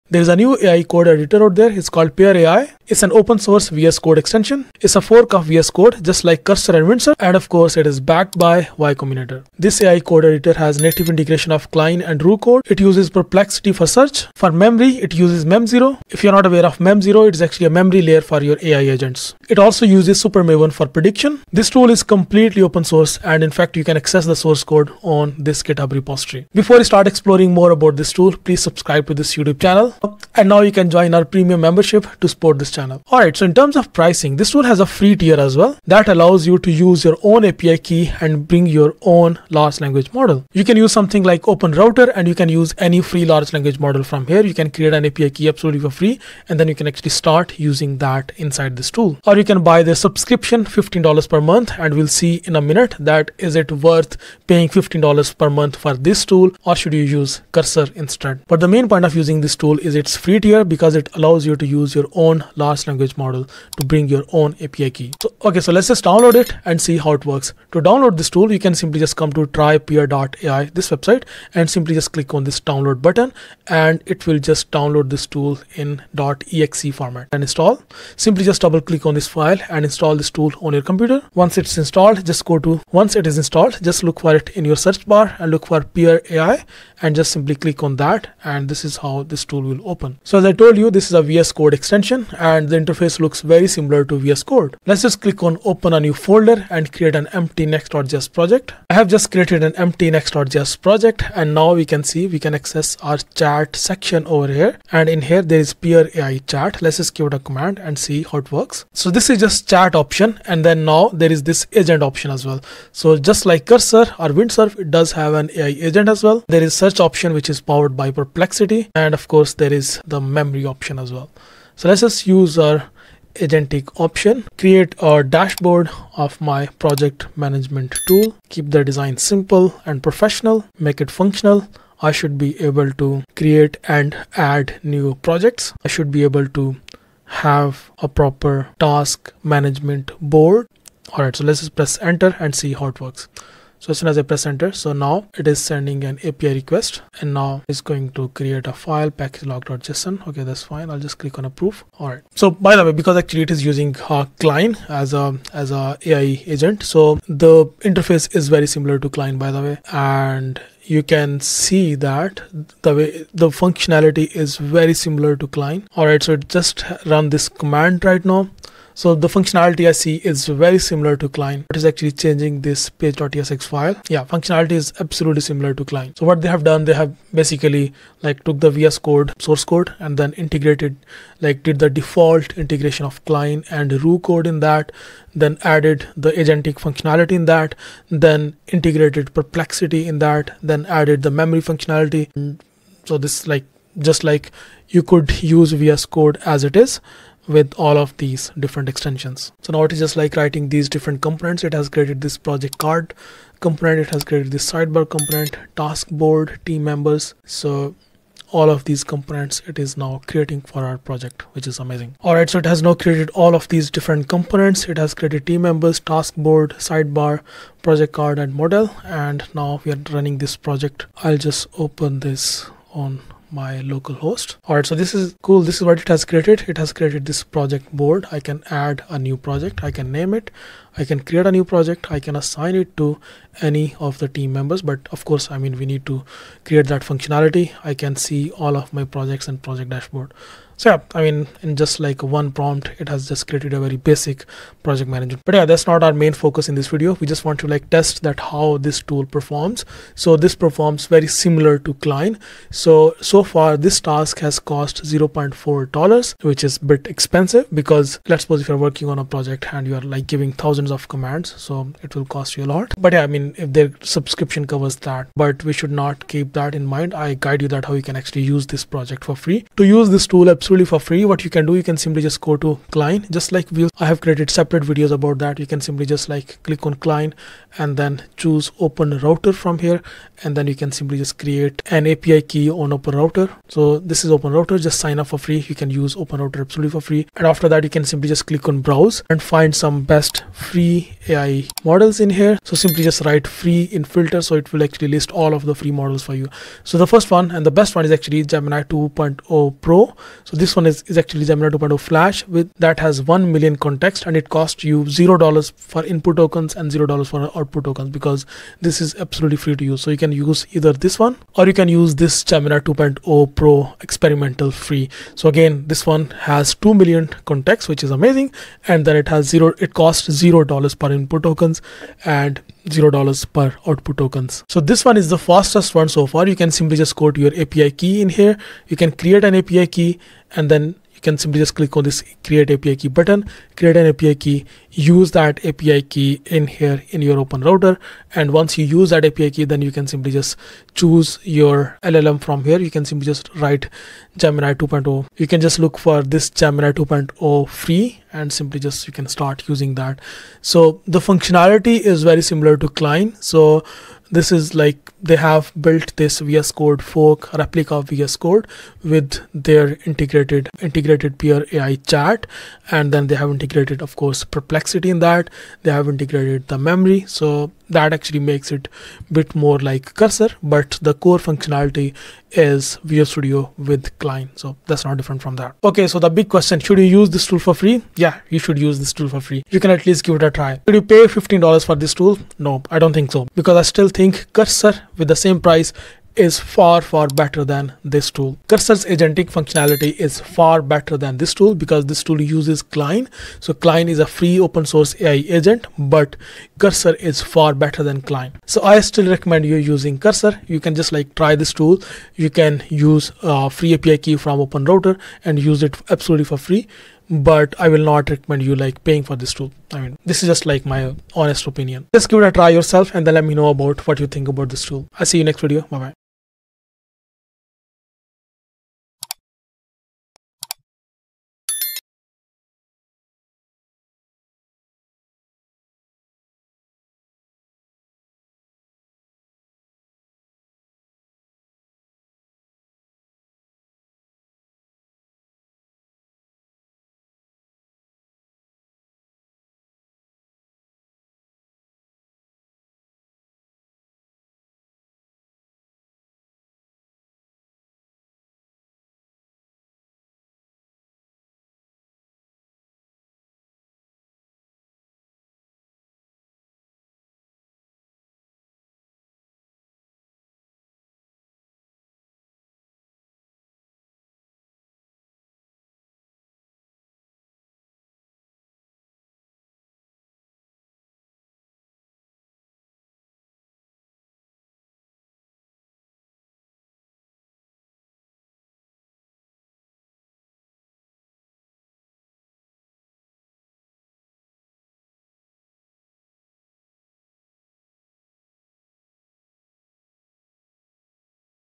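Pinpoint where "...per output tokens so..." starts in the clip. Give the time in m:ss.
5:23.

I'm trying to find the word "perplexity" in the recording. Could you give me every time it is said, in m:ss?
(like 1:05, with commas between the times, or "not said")
0:13, 1:58, 3:09, 6:04.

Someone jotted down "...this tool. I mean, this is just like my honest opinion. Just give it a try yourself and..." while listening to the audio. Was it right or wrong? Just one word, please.
right.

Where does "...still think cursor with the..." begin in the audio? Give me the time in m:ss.
6:23.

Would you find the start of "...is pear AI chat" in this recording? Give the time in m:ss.
1:45.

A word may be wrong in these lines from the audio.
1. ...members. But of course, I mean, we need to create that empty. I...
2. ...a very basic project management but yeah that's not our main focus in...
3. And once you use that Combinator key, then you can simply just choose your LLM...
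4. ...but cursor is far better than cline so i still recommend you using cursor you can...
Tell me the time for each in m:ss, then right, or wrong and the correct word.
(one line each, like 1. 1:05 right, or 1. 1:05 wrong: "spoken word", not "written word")
1. 3:54 wrong: "functionality", not "empty"
2. 4:03 right
3. 5:38 wrong: "API", not "Combinator"
4. 6:35 right.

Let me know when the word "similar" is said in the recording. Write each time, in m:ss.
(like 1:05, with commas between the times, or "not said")
1:33, 2:38, 2:44, 2:50, 2:55, 4:11, 5:52.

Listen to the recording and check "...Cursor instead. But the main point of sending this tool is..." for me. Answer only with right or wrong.
wrong.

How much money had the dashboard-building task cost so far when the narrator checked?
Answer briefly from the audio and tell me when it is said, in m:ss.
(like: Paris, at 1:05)
0.4 dollars, at 4:15.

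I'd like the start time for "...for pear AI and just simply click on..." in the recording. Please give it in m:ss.
1:25.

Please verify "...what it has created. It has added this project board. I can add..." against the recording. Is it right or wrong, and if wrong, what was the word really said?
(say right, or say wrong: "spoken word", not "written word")
wrong: "created", not "added".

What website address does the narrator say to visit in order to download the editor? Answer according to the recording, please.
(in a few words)
trypear.ai.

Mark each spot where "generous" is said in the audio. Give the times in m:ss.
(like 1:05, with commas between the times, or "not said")
not said.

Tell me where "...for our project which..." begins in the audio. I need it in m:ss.
3:30.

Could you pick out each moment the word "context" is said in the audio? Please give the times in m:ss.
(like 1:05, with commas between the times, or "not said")
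5:03, 5:17.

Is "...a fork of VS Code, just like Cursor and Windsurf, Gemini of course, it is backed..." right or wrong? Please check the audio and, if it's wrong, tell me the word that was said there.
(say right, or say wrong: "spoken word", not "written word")
wrong: "And", not "Gemini".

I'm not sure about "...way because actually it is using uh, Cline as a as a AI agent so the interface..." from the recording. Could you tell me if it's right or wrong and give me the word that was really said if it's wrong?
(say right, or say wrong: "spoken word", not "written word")
right.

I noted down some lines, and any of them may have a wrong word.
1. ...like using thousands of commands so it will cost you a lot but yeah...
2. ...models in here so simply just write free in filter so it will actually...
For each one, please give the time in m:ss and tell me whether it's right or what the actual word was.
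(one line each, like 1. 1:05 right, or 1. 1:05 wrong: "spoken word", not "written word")
1. 4:20 wrong: "giving", not "using"
2. 4:51 right.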